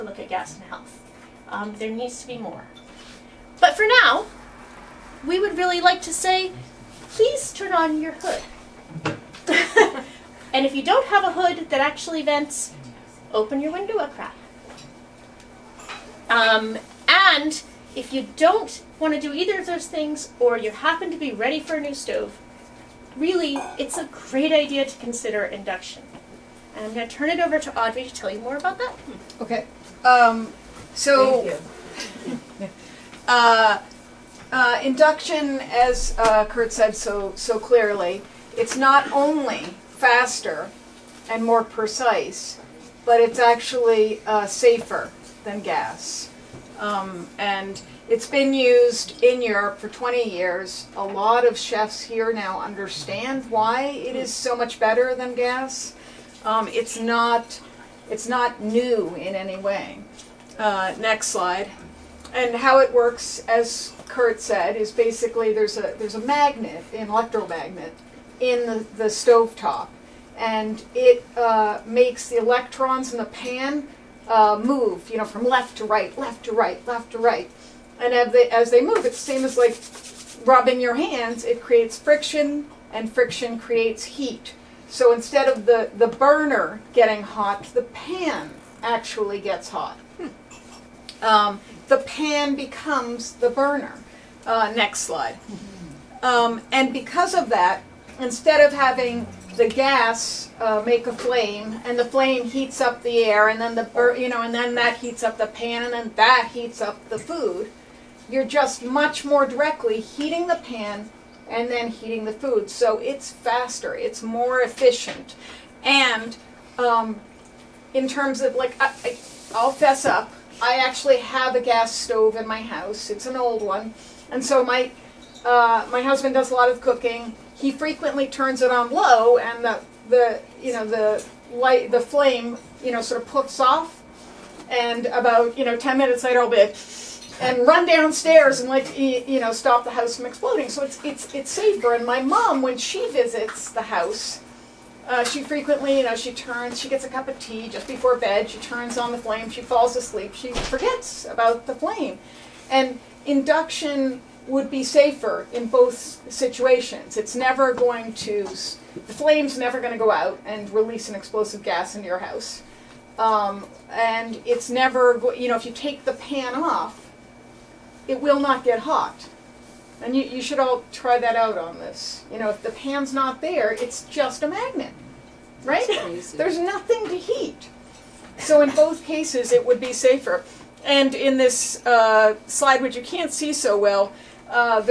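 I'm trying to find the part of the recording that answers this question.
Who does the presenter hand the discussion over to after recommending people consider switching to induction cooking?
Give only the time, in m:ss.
0:27.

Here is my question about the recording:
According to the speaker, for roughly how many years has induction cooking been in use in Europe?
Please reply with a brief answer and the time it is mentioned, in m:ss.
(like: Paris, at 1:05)
20 years, at 0:49.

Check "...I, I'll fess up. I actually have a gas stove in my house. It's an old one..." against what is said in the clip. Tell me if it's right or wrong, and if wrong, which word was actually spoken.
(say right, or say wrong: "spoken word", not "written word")
right.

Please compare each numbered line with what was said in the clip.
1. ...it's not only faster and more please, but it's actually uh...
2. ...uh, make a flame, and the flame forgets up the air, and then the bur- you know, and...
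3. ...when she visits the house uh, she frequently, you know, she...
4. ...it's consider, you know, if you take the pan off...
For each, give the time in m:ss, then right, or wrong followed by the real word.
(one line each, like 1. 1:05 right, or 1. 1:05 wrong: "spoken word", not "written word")
1. 0:38 wrong: "precise", not "please"
2. 1:40 wrong: "heats", not "forgets"
3. 2:22 right
4. 2:44 wrong: "never", not "consider".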